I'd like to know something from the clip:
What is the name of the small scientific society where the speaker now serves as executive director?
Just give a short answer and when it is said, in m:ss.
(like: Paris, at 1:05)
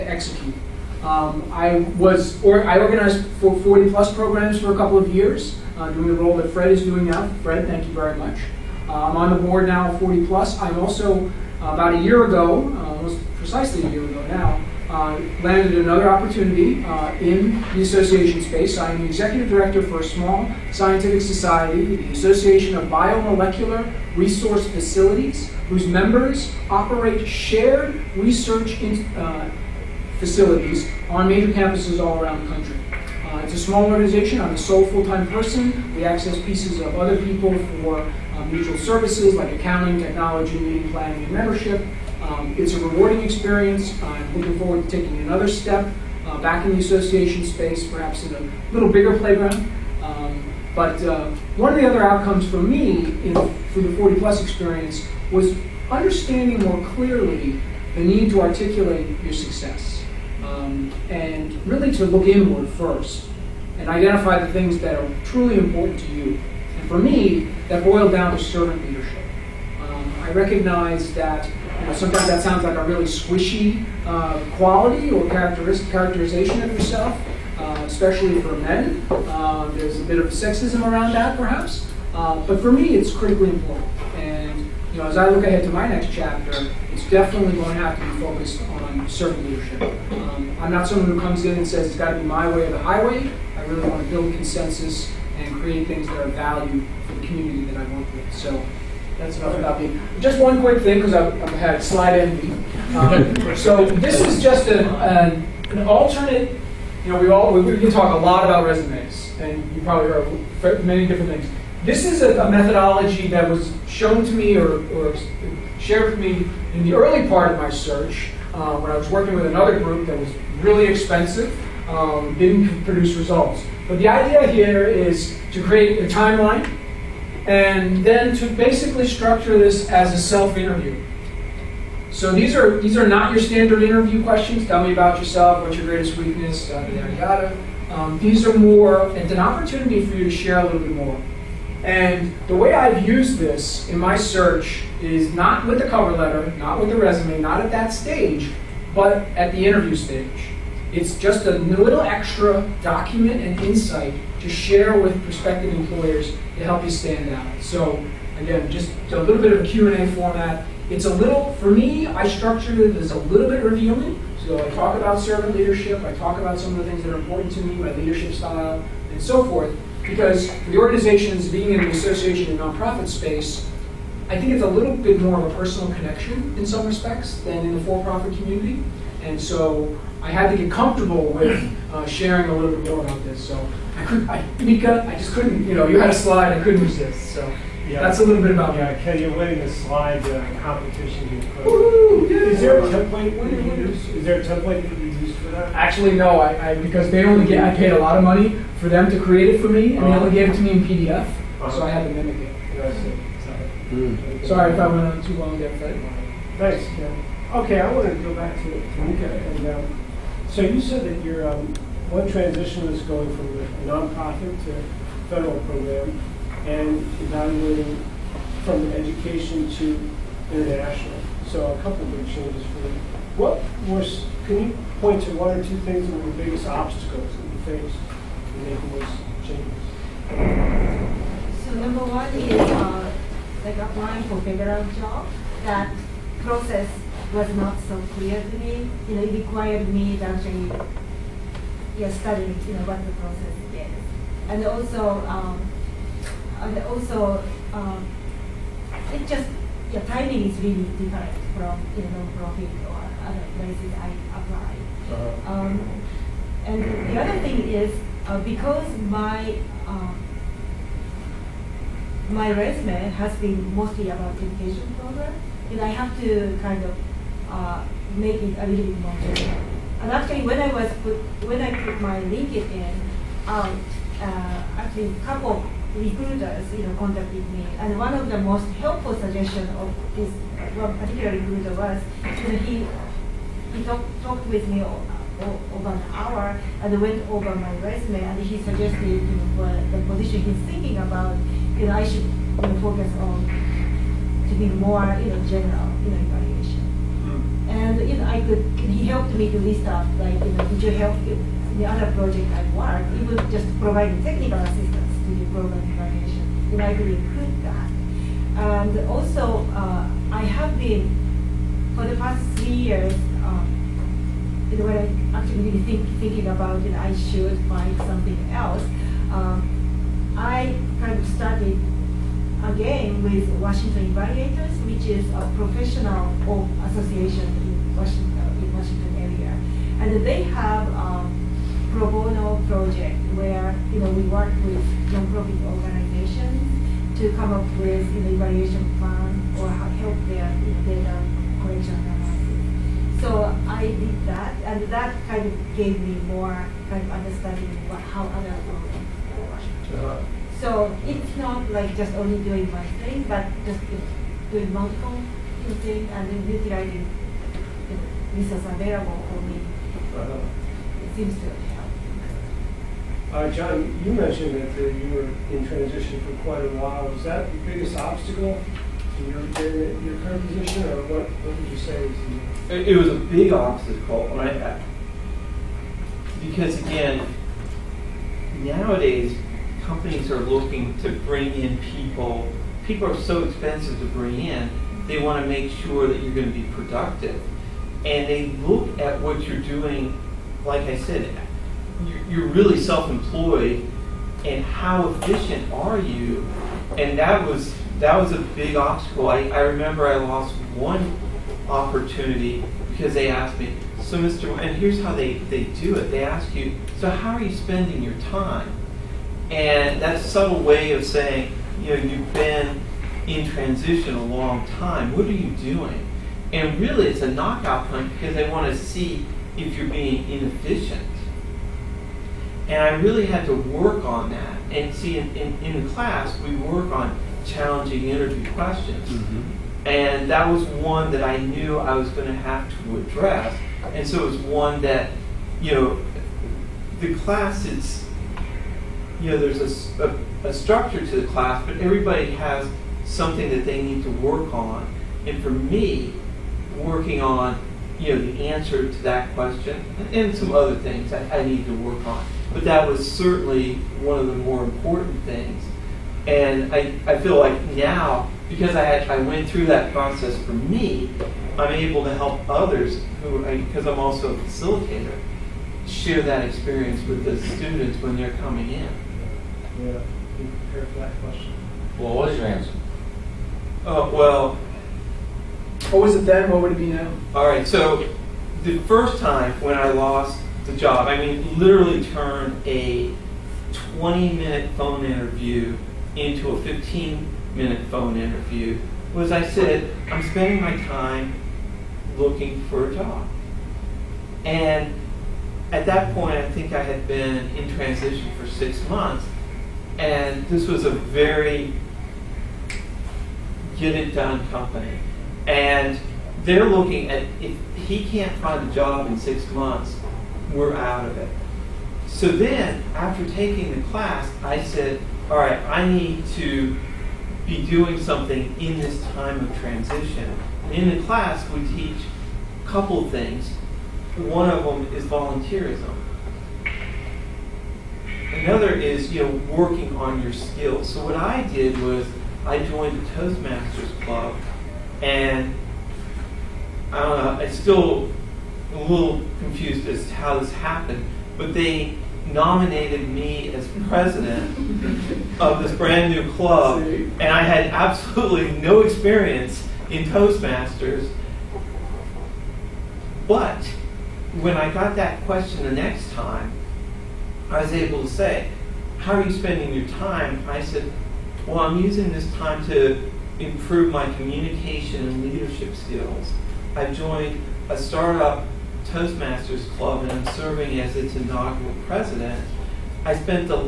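Association of Biomolecular Resource Facilities, at 0:22.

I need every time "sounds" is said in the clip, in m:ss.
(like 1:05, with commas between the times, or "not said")
1:12.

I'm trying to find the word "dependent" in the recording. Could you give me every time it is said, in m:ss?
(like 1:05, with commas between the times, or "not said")
not said.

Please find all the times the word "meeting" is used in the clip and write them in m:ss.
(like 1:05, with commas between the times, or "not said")
0:40.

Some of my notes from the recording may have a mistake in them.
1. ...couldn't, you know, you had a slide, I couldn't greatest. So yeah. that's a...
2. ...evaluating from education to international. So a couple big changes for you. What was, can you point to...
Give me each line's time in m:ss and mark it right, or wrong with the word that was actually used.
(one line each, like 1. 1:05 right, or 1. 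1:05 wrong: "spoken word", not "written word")
1. 3:05 wrong: "resist", not "greatest"
2. 3:37 right.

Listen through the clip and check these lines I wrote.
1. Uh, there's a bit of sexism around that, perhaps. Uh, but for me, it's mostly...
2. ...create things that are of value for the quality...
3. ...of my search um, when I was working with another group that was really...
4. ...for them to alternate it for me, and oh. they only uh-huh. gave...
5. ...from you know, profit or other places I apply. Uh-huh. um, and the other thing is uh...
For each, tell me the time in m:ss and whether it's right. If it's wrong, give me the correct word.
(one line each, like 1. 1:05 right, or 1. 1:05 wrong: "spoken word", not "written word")
1. 1:19 wrong: "critically", not "mostly"
2. 1:35 wrong: "community", not "quality"
3. 1:57 right
4. 3:18 wrong: "create", not "alternate"
5. 4:11 right.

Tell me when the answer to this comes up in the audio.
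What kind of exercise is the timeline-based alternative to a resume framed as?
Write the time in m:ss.
2:10.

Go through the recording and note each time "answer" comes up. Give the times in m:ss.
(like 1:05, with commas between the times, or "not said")
7:28, 7:52.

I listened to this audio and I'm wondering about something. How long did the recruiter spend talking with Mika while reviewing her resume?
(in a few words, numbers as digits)
Over an hour.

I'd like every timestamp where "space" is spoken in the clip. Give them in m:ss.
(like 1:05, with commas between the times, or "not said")
0:18, 0:47, 2:53.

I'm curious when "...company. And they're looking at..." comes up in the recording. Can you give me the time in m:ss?
8:24.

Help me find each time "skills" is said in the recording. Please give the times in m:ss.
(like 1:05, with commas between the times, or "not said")
8:50, 9:25.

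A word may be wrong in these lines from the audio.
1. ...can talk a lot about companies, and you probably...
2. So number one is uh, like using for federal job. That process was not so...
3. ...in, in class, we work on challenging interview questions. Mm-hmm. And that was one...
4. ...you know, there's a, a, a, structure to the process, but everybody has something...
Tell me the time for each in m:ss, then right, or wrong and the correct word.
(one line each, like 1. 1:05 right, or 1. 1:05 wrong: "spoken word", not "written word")
1. 1:47 wrong: "resumes", not "companies"
2. 3:51 wrong: "applying", not "using"
3. 7:05 right
4. 7:19 wrong: "class", not "process".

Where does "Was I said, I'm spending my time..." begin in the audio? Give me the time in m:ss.
8:09.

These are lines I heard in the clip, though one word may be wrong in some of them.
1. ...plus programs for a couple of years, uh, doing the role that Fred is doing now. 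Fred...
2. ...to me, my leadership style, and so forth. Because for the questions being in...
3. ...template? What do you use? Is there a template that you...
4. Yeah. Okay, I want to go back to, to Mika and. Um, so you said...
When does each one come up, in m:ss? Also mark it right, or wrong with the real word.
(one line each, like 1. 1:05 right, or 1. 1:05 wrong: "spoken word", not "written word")
1. 0:03 right
2. 2:47 wrong: "organizations", not "questions"
3. 3:12 right
4. 3:26 right.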